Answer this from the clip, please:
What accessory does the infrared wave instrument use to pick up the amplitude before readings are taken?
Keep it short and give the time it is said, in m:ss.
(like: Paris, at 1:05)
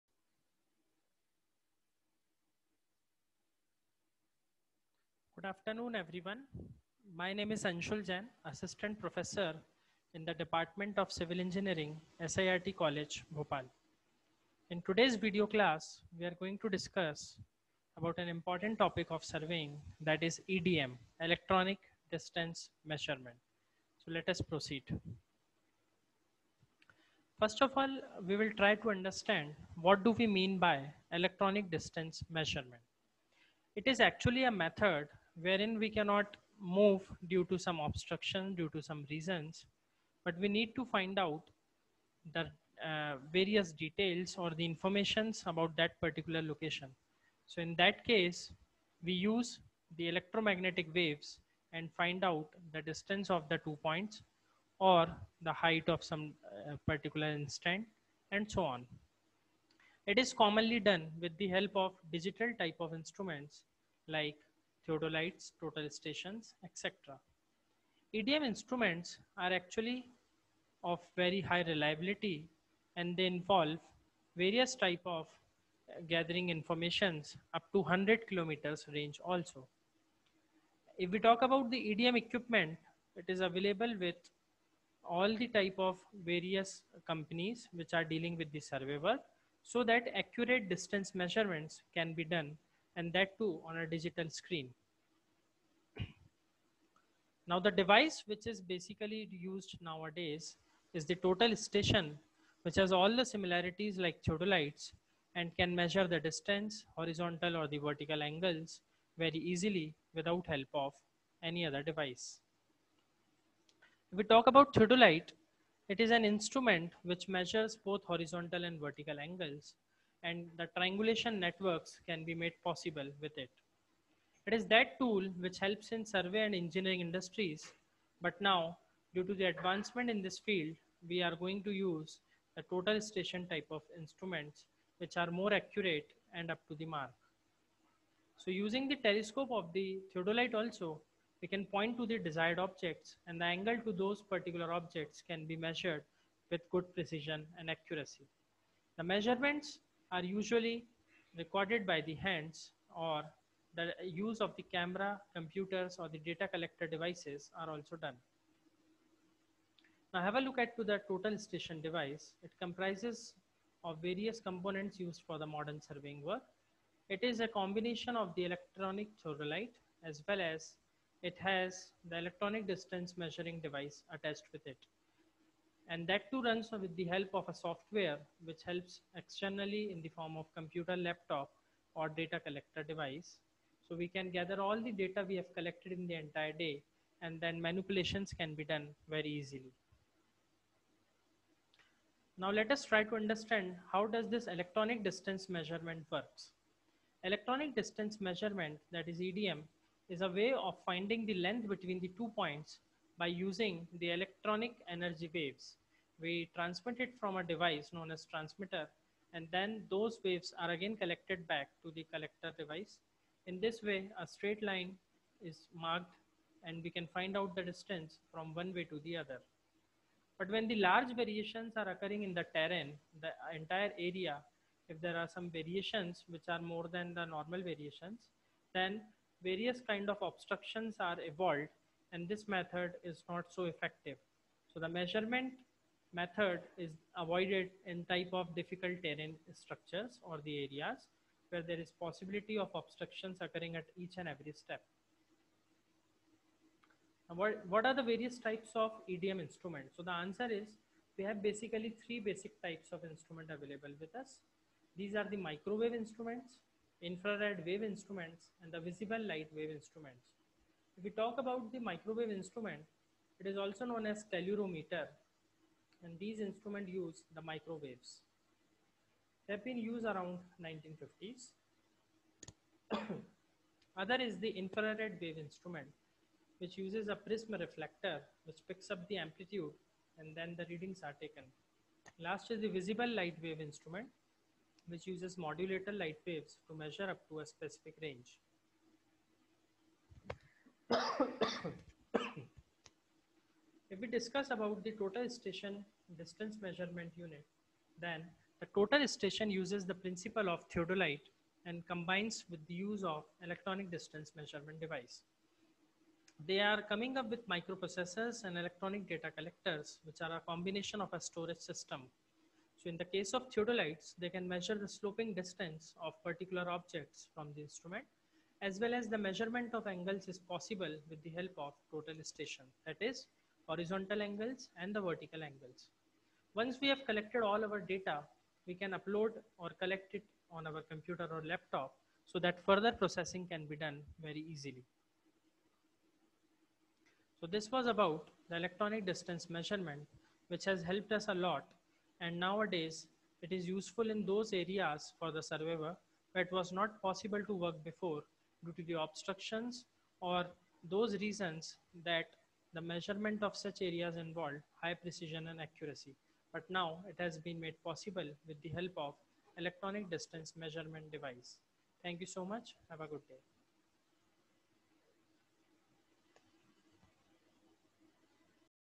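prism reflector, at 4:37.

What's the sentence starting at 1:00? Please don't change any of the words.
It is commonly done with the help of digital type of instruments like theodolites, total stations, etc.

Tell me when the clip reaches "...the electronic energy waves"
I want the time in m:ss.
3:23.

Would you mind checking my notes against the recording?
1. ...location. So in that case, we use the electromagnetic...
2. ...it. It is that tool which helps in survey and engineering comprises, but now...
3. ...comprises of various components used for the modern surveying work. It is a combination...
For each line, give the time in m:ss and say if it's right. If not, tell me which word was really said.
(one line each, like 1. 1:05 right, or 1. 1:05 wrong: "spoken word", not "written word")
1. 0:46 right
2. 2:03 wrong: "industries", not "comprises"
3. 2:42 right.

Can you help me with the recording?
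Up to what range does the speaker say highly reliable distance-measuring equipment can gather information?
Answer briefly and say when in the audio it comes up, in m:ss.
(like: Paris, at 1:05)
100 kilometers, at 1:17.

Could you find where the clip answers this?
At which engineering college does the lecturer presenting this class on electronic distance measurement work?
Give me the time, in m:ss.
0:12.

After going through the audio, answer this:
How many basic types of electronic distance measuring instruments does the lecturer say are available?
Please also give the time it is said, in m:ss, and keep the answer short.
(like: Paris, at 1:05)
3, at 4:12.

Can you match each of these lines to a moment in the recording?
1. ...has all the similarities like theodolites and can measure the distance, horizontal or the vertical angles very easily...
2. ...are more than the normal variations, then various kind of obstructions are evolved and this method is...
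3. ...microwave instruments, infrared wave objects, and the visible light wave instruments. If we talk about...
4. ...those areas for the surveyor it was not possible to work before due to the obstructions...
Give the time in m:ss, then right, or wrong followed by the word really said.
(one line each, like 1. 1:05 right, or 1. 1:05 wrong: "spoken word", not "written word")
1. 1:42 right
2. 3:46 right
3. 4:15 wrong: "instruments", not "objects"
4. 5:44 right.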